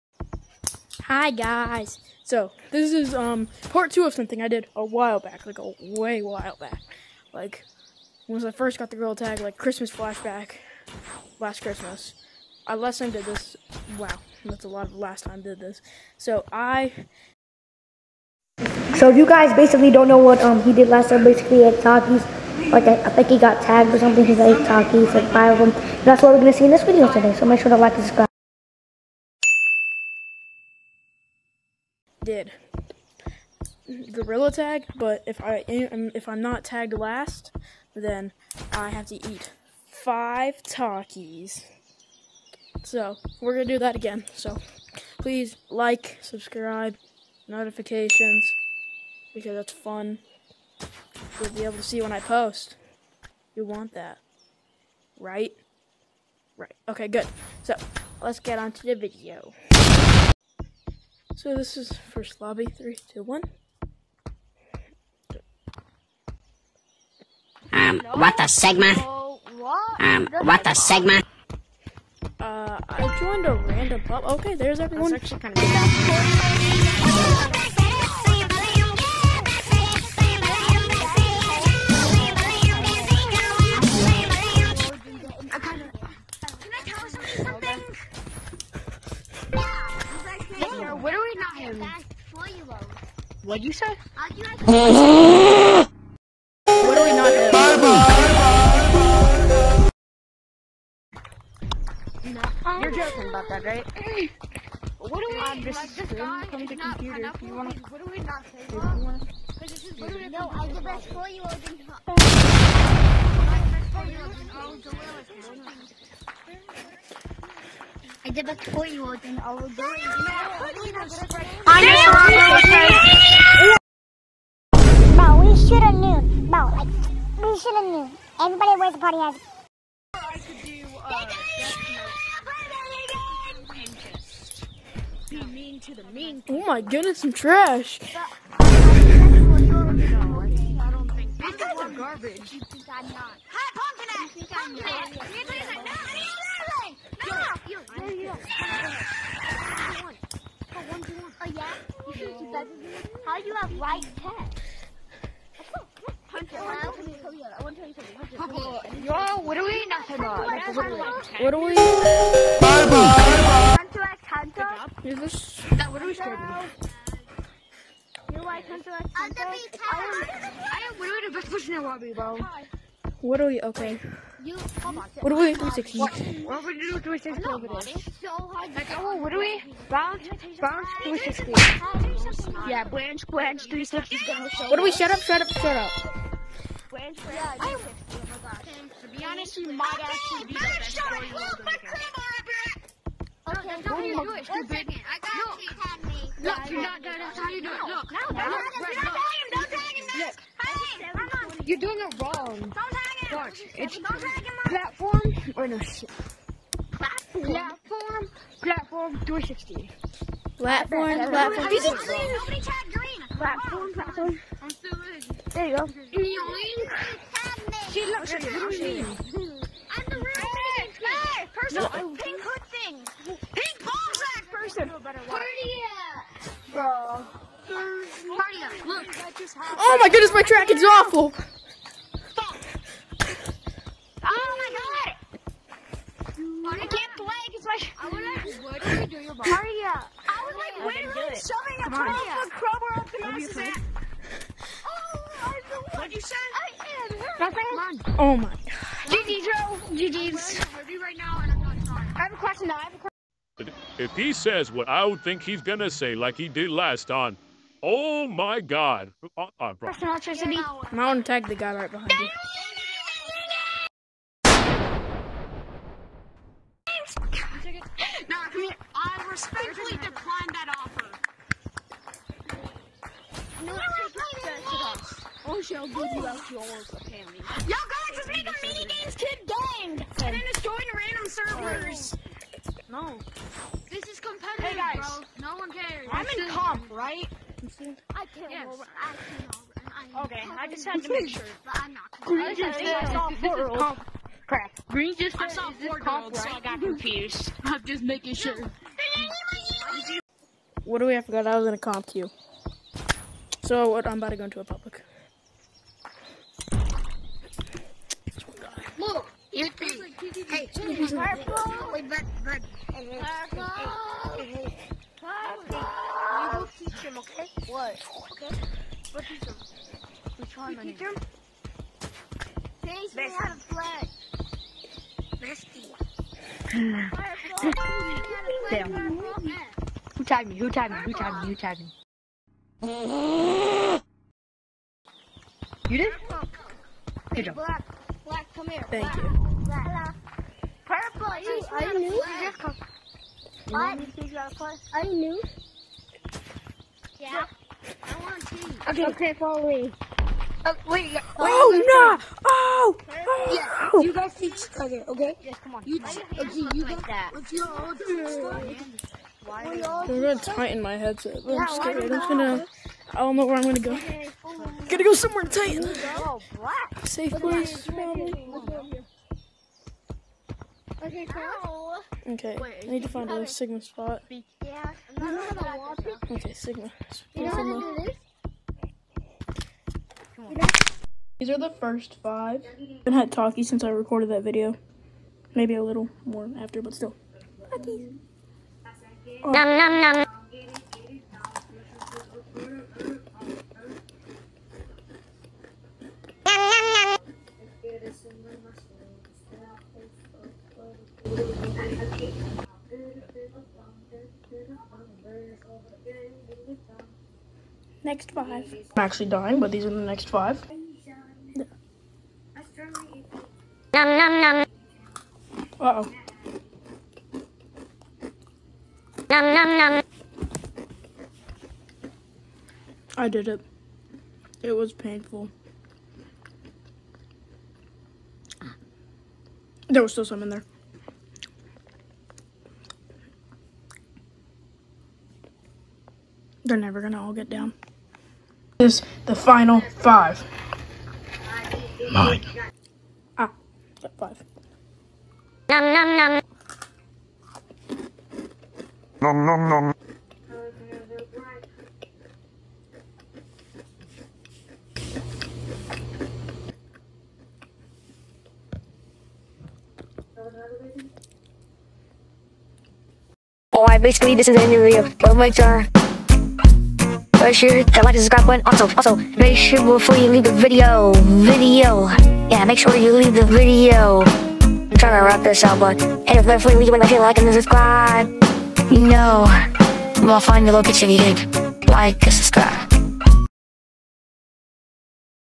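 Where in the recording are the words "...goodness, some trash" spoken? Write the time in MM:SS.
02:16.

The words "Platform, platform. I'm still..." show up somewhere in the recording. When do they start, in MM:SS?
03:33.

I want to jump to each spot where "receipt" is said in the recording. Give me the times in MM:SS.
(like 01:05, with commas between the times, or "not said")
not said.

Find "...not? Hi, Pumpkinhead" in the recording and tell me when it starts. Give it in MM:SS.
02:23.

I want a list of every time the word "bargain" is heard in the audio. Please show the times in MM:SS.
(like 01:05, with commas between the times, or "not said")
not said.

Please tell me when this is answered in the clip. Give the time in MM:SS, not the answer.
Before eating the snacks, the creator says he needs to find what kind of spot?
06:13.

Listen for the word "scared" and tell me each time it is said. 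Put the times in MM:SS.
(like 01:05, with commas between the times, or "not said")
02:46.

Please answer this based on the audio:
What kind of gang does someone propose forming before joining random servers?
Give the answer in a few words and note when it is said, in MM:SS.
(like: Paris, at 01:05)
mini games kid gang, at 04:38.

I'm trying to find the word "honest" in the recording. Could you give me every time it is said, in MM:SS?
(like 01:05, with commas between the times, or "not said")
03:09.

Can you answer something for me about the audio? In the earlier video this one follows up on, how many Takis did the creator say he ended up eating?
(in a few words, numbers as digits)
8.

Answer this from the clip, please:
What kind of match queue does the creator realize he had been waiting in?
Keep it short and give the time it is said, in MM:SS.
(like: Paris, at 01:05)
comp queue, at 05:01.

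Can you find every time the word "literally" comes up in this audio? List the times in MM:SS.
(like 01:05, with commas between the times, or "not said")
01:49, 04:00.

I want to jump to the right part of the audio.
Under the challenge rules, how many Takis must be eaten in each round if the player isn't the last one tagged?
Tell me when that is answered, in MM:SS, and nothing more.
00:39.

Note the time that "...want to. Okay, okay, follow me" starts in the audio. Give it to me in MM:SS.
05:48.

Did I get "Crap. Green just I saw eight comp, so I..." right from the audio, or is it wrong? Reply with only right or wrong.
wrong.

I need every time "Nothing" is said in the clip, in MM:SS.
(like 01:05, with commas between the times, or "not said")
04:07.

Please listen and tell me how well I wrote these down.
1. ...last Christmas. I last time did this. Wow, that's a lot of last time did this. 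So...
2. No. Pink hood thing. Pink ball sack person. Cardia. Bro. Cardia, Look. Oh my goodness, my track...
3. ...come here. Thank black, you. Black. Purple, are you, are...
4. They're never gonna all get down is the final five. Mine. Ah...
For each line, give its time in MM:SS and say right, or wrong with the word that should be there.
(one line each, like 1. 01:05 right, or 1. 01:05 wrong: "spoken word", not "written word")
1. 00:11 right
2. 03:41 right
3. 05:38 right
4. 07:16 right.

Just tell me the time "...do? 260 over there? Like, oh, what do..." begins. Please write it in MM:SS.
02:56.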